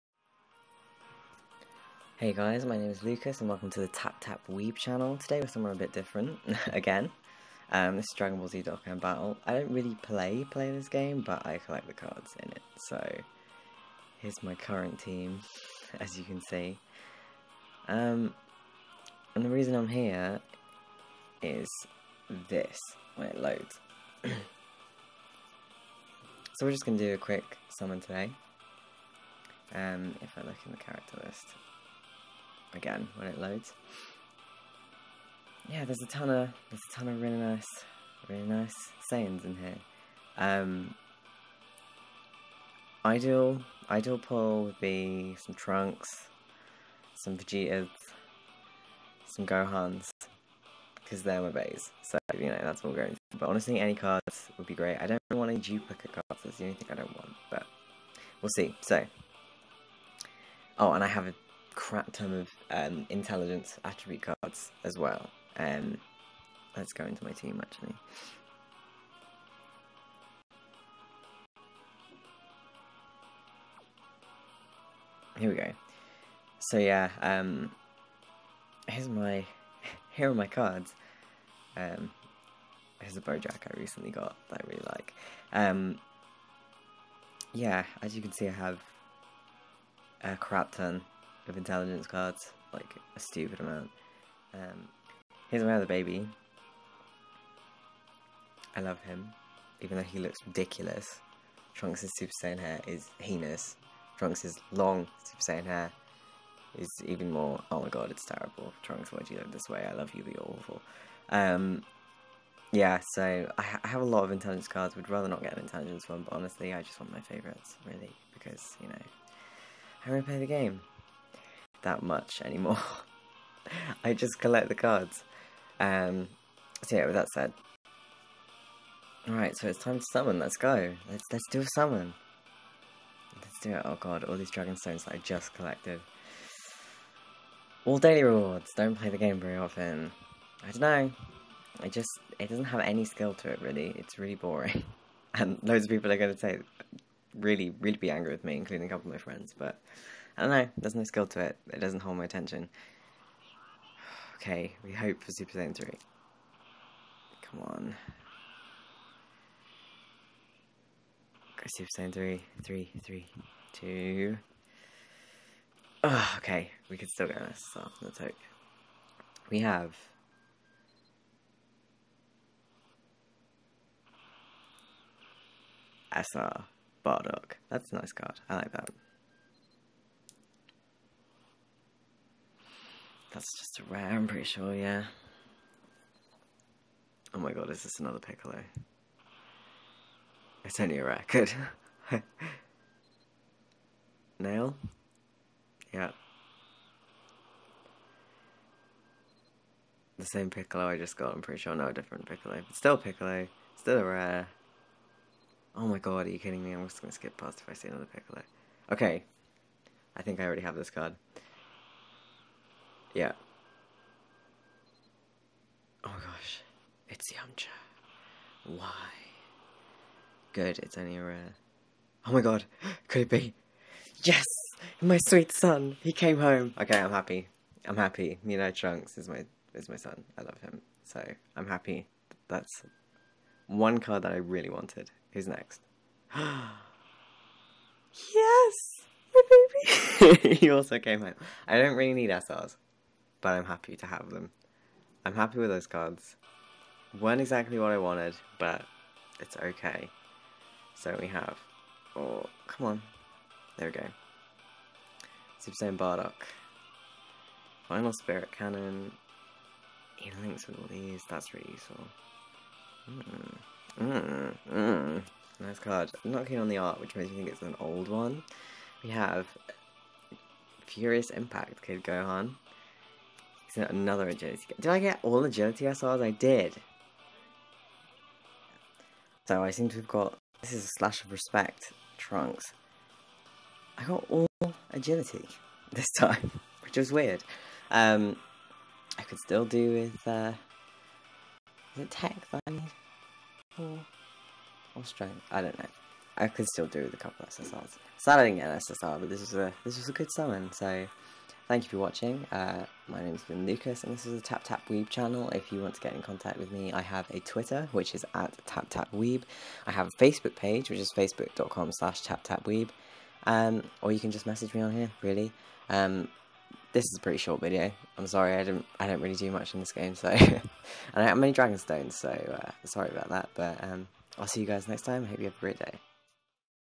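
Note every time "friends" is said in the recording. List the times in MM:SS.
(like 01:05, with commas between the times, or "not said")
02:29.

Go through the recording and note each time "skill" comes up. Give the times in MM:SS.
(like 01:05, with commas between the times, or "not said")
02:23, 02:31.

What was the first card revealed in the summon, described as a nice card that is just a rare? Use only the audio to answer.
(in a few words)
SR Bardock.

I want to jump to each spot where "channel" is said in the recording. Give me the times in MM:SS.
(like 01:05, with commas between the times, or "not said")
00:04, 05:05.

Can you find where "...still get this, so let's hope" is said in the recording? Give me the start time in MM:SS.
02:47.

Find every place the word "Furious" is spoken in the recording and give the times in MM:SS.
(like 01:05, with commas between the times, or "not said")
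04:30.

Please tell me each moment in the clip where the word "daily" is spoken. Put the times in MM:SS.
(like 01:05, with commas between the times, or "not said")
02:17.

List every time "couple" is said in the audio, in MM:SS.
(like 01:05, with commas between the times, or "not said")
02:28, 04:57.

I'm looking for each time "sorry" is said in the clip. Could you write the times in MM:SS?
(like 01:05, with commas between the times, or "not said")
05:18, 05:22.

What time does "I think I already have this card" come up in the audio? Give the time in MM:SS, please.
03:30.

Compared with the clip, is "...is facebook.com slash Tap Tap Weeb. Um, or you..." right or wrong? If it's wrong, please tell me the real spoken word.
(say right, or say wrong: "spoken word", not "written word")
right.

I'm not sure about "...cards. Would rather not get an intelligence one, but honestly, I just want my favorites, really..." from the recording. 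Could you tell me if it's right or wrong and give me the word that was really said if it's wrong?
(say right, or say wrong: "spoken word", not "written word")
right.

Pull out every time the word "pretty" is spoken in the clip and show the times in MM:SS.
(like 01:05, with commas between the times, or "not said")
03:04, 03:21, 05:17.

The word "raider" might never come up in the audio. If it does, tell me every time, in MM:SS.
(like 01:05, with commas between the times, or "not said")
not said.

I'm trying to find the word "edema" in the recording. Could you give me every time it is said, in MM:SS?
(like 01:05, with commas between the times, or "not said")
not said.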